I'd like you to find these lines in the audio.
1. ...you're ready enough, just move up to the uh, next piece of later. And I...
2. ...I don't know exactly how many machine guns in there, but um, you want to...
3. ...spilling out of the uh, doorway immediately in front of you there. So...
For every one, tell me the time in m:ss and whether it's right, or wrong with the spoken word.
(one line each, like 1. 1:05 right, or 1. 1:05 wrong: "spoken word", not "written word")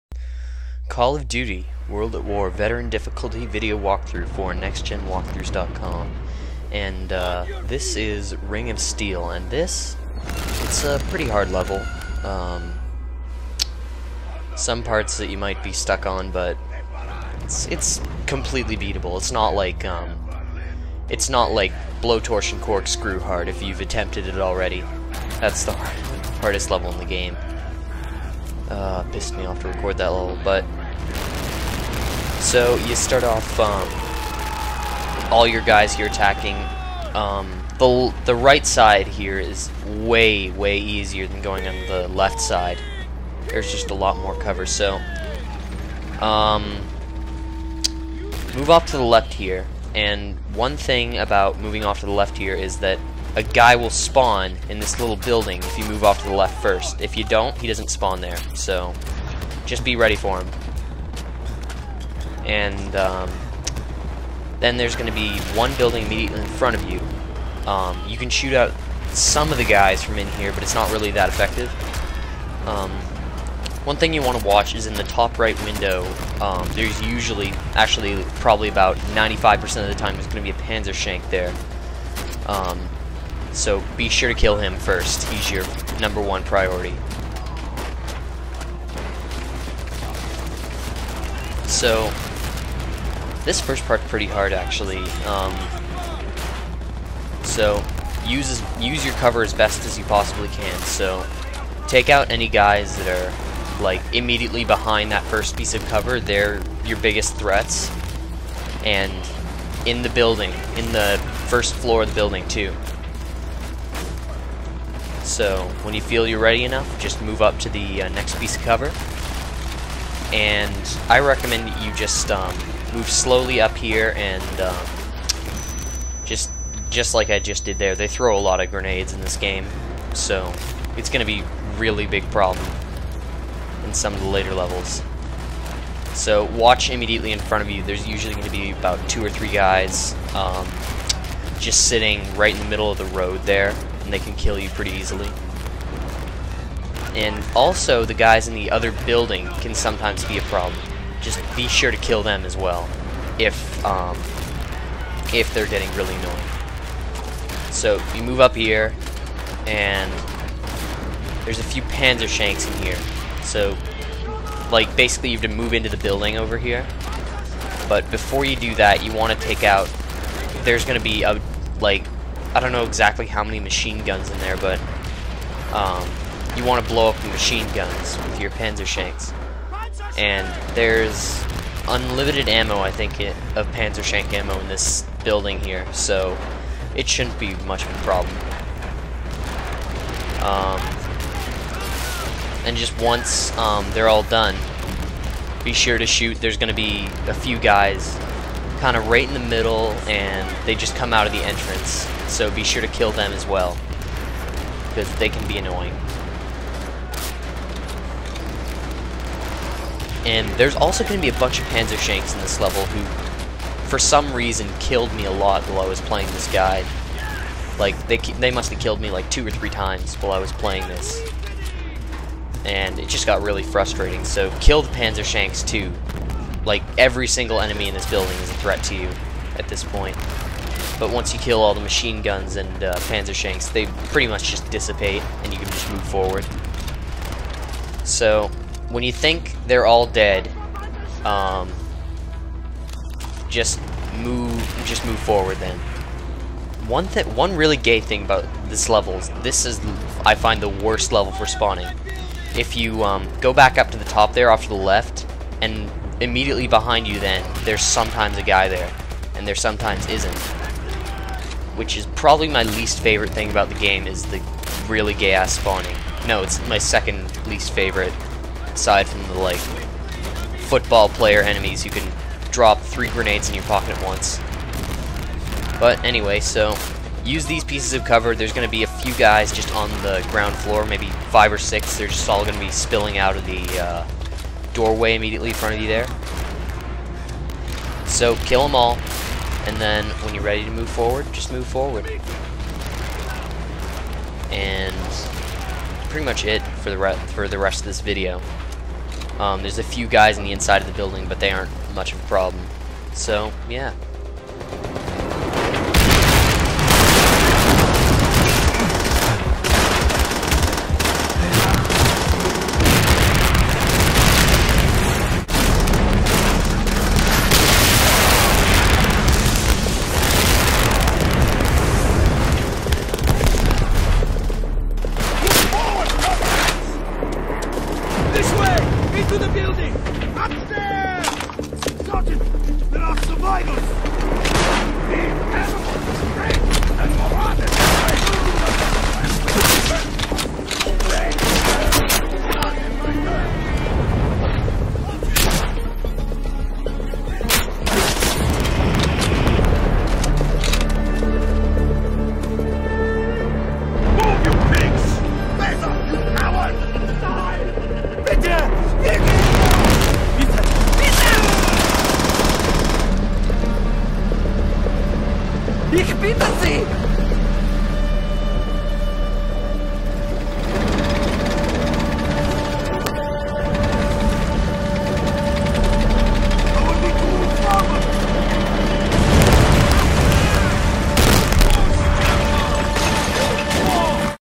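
1. 1:56 wrong: "cover", not "later"
2. 2:52 right
3. 4:42 right.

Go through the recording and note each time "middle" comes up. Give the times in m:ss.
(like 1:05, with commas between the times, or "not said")
2:22, 3:19.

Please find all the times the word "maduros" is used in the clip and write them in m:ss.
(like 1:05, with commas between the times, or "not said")
not said.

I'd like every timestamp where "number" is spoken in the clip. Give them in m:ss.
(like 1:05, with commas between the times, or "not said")
1:25.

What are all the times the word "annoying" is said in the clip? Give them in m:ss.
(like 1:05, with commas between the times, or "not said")
2:36, 3:25.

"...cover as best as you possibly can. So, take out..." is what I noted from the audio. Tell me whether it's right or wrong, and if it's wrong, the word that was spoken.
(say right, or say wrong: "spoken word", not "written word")
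right.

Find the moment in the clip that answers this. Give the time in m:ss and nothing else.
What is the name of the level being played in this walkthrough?
0:08.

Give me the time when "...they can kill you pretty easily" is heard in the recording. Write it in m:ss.
2:24.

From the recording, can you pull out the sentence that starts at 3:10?
Um, and just once um, they're all done, be sure to shoot.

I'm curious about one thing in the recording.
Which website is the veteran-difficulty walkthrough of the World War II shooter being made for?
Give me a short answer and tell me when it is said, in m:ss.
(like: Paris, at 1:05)
NextGenWalkthroughs.com, at 0:04.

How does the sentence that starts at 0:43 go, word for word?
There's just a lot more cover, so...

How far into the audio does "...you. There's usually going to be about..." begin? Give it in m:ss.
2:17.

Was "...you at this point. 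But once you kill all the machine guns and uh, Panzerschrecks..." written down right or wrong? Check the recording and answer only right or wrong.
right.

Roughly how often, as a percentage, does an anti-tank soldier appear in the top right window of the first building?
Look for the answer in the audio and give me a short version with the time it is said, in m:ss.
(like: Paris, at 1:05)
95%, at 1:18.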